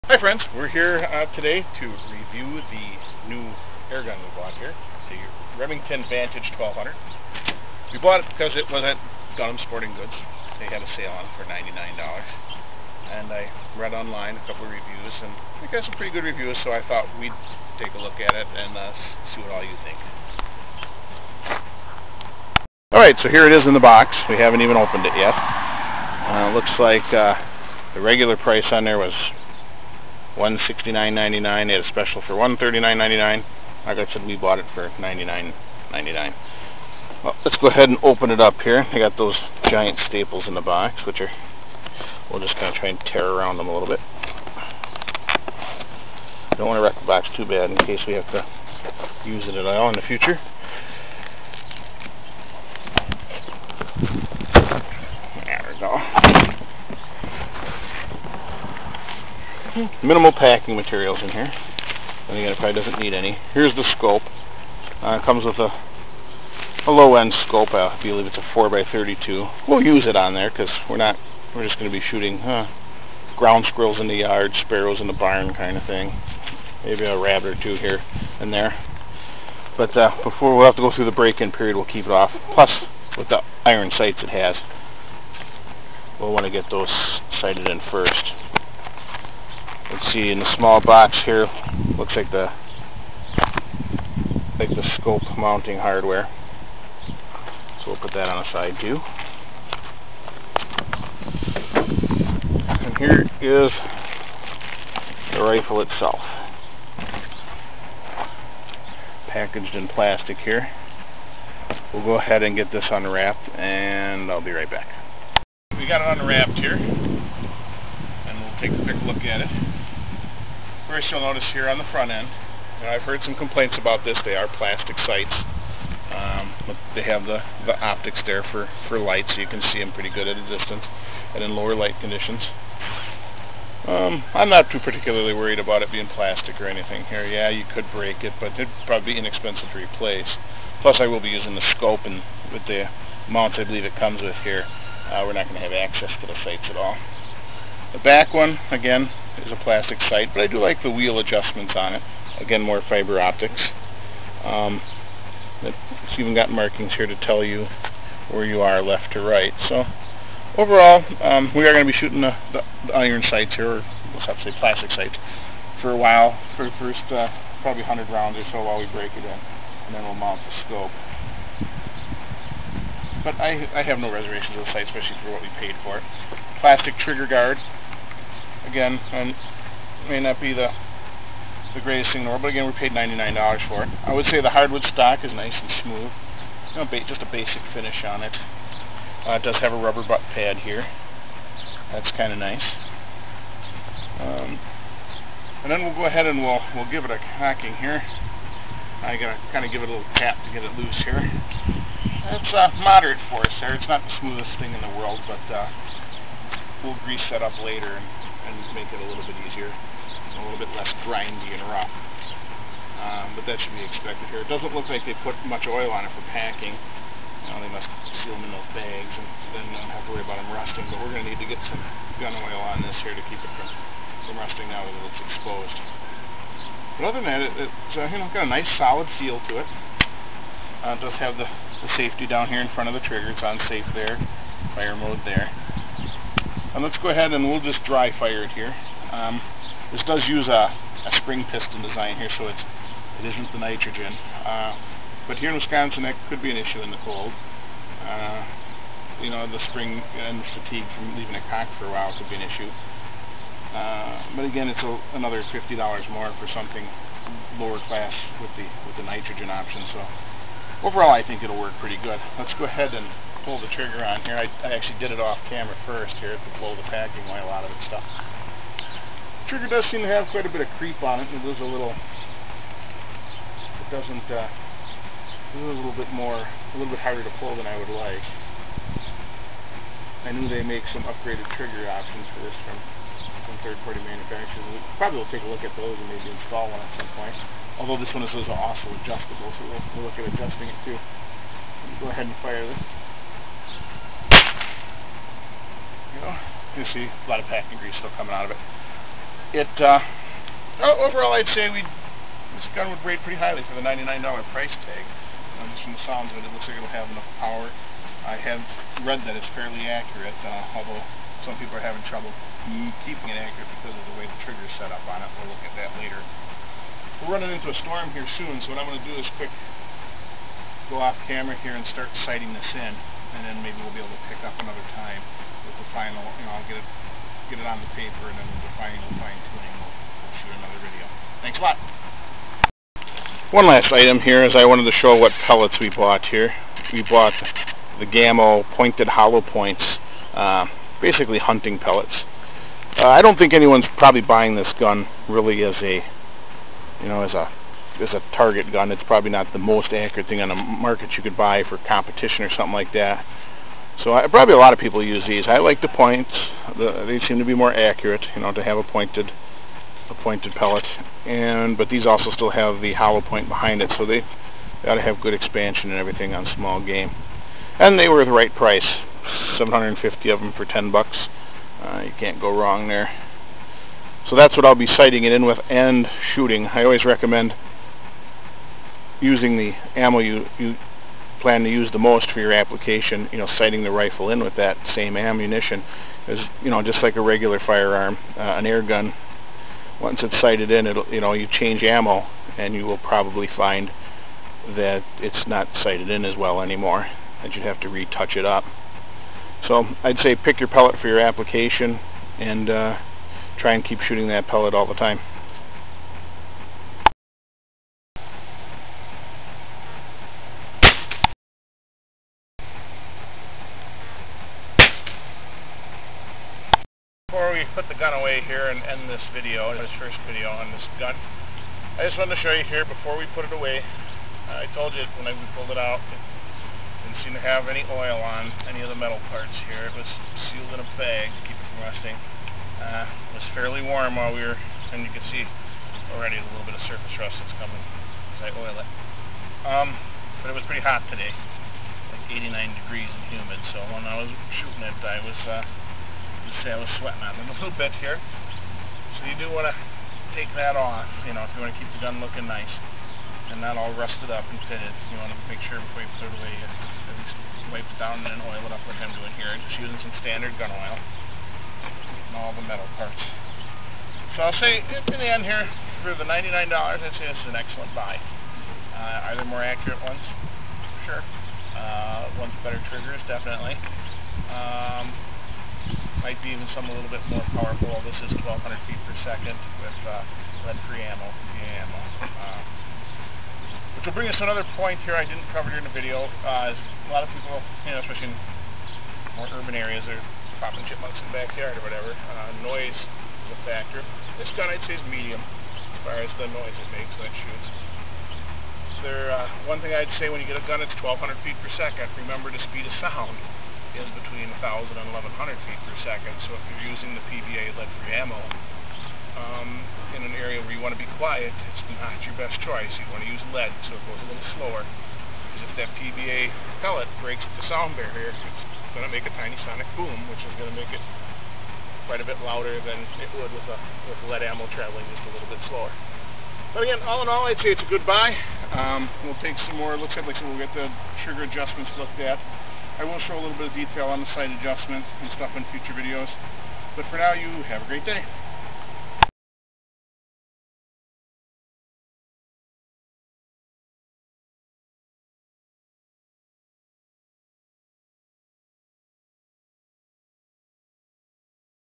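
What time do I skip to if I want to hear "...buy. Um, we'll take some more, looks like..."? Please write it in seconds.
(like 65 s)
528 s.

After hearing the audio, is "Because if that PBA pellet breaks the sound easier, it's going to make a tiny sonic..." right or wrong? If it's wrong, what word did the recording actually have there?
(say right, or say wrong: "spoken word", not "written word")
wrong: "barrier", not "easier".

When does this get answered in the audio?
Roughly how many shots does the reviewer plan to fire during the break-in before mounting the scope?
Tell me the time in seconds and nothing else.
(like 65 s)
167 s.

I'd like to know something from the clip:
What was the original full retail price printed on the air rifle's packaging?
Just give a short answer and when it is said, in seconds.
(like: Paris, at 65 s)
$169.99, at 30 s.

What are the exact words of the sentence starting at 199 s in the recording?
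I gotta kind of give it a little tap to get it loose here.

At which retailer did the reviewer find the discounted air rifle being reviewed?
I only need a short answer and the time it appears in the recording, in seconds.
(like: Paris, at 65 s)
Dunham Sporting Goods, at 9 s.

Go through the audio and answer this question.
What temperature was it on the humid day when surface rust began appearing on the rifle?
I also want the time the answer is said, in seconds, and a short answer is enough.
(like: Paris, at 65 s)
89 degrees, at 442 s.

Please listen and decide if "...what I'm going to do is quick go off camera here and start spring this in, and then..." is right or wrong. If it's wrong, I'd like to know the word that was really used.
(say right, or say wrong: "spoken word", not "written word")
wrong: "sighting", not "spring".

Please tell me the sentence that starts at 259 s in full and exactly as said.
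So overall, I think it'll work pretty good.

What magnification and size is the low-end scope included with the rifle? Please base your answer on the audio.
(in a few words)
4x32.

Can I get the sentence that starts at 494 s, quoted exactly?
This gun, I'd say, is medium as far as the noise it makes when it shoots.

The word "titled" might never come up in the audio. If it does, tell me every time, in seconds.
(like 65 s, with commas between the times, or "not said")
not said.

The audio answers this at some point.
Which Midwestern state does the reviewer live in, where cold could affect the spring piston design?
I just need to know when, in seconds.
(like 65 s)
245 s.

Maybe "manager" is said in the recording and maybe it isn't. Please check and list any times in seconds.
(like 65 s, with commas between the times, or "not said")
not said.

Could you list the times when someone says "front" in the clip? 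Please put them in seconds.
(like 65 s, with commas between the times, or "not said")
121 s, 232 s.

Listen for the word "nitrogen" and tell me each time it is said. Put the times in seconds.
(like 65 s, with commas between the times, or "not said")
243 s, 259 s.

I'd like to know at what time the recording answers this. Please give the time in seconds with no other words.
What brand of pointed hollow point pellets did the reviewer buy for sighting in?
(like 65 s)
338 s.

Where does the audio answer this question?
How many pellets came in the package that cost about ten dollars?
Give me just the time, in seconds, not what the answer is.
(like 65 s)
369 s.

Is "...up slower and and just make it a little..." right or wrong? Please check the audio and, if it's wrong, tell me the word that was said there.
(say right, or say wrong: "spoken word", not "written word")
wrong: "later", not "slower".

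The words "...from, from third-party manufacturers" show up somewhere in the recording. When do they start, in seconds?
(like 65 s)
282 s.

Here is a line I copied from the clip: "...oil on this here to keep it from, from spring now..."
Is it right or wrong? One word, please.
wrong.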